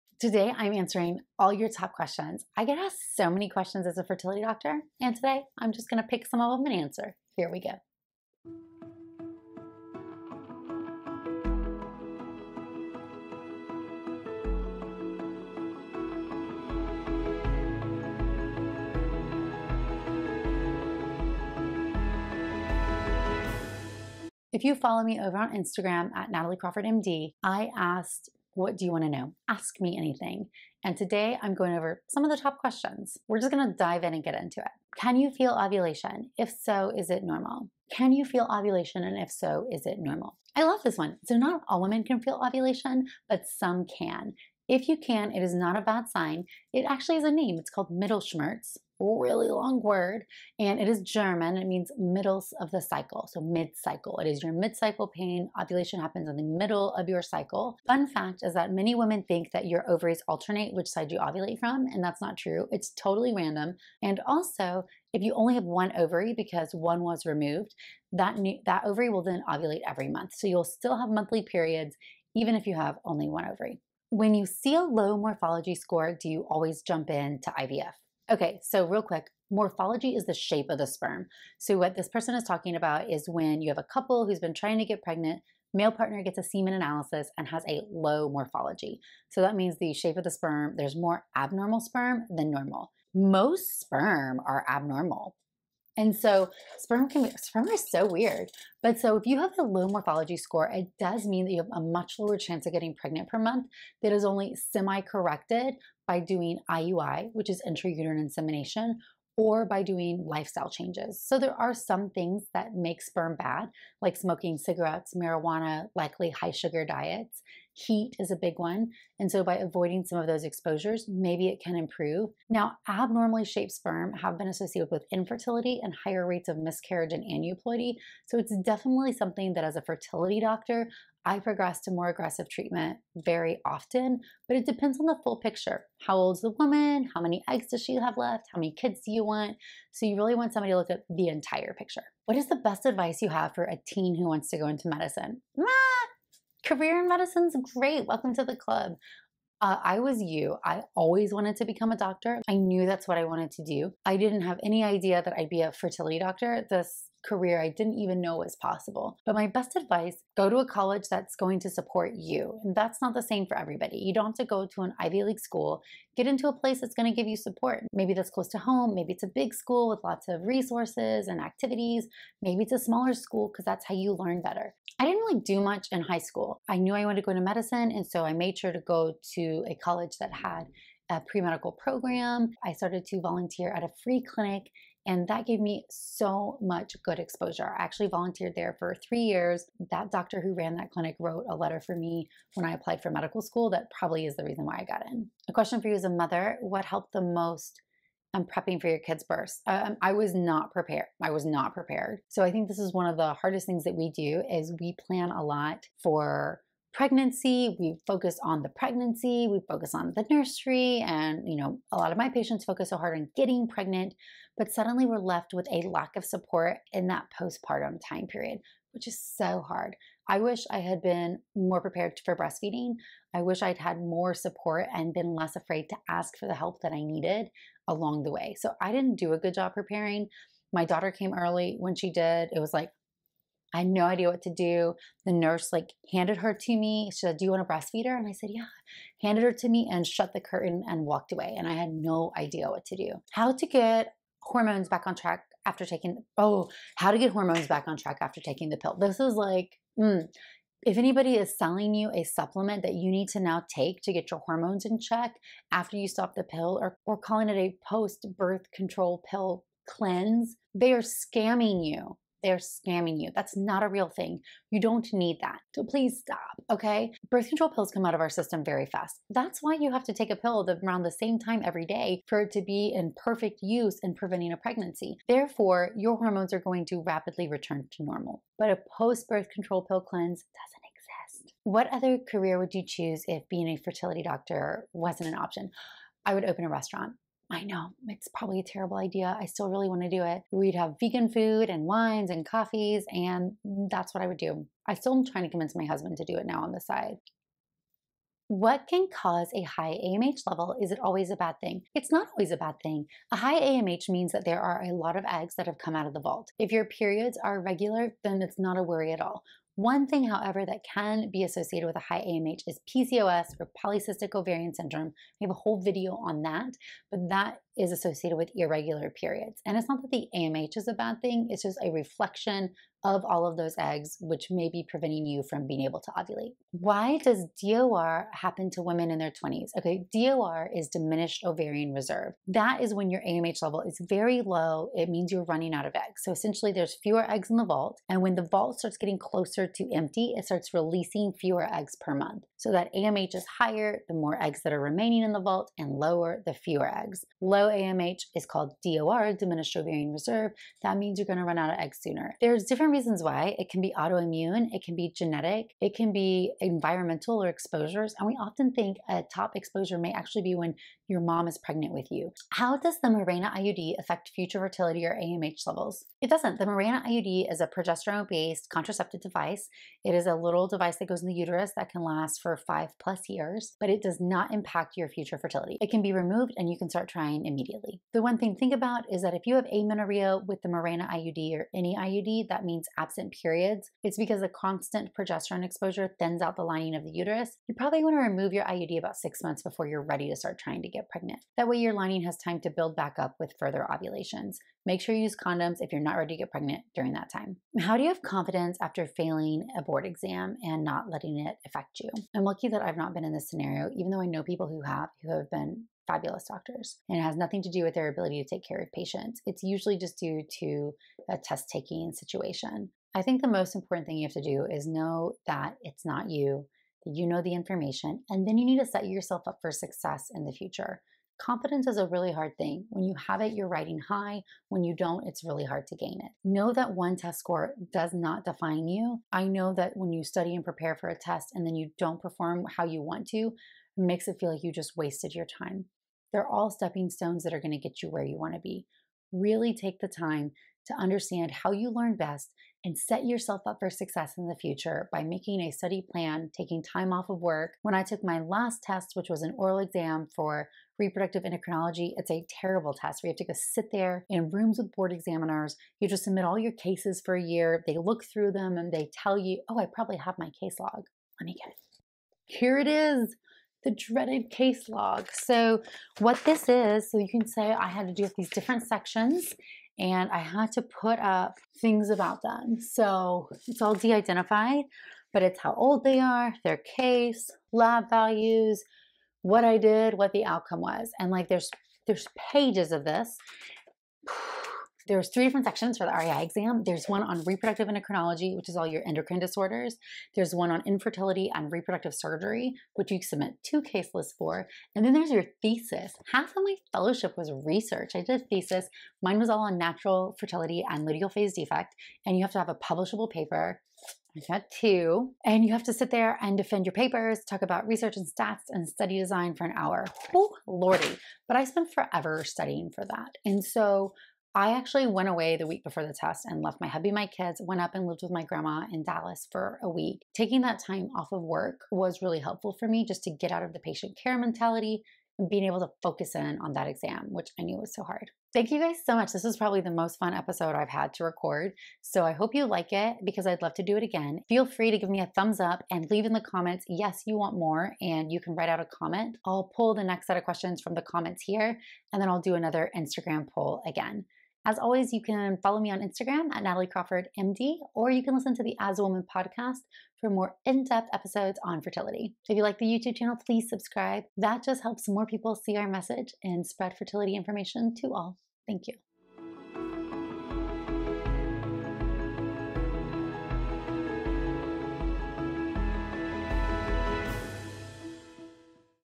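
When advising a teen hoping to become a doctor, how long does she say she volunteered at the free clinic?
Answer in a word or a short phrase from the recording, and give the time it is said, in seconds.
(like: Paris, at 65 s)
3 years, at 189 s.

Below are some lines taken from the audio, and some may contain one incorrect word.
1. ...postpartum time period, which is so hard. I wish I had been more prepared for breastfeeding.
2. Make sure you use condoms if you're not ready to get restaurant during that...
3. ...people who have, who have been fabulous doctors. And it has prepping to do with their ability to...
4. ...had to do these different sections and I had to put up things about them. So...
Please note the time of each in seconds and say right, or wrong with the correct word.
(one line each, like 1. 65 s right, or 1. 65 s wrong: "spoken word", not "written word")
1. 217 s right
2. 394 s wrong: "pregnant", not "restaurant"
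3. 404 s wrong: "nothing", not "prepping"
4. 467 s right.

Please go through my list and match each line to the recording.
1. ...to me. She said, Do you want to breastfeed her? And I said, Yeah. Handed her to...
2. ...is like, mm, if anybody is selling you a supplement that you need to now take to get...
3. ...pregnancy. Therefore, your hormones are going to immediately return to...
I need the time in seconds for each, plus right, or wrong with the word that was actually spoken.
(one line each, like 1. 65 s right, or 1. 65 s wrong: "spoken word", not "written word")
1. 236 s right
2. 249 s right
3. 274 s wrong: "rapidly", not "immediately".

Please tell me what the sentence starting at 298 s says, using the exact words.
What can cause a high AMH level?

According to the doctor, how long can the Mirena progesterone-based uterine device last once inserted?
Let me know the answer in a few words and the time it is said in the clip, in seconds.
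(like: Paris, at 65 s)
5 plus years, at 372 s.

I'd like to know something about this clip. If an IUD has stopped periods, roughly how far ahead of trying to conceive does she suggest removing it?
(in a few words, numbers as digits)
6 months.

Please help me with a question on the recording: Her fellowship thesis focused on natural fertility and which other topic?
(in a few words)
luteal phase defect.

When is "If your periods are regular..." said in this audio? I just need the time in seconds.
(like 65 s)
306 s.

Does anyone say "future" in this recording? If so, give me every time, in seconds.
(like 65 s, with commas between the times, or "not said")
364 s, 375 s, 420 s, 444 s.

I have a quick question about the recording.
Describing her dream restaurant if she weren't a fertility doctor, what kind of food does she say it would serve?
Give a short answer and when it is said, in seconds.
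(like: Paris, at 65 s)
vegan food, at 291 s.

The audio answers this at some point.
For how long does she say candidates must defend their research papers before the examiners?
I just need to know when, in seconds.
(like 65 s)
509 s.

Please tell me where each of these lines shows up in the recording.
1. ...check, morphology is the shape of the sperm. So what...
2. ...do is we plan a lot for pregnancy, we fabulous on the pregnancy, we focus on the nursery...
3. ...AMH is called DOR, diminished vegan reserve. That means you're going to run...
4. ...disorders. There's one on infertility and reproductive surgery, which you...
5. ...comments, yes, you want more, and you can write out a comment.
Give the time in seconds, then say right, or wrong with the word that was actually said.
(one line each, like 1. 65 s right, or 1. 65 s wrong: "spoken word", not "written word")
1. 79 s wrong: "quick", not "check"
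2. 204 s wrong: "focus", not "fabulous"
3. 347 s wrong: "ovarian", not "vegan"
4. 489 s right
5. 536 s right.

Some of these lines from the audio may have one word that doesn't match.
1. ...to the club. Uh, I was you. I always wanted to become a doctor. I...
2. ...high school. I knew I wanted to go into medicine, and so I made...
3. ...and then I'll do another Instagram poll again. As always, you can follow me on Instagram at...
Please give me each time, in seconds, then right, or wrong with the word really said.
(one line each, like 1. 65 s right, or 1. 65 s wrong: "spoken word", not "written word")
1. 148 s right
2. 176 s right
3. 542 s right.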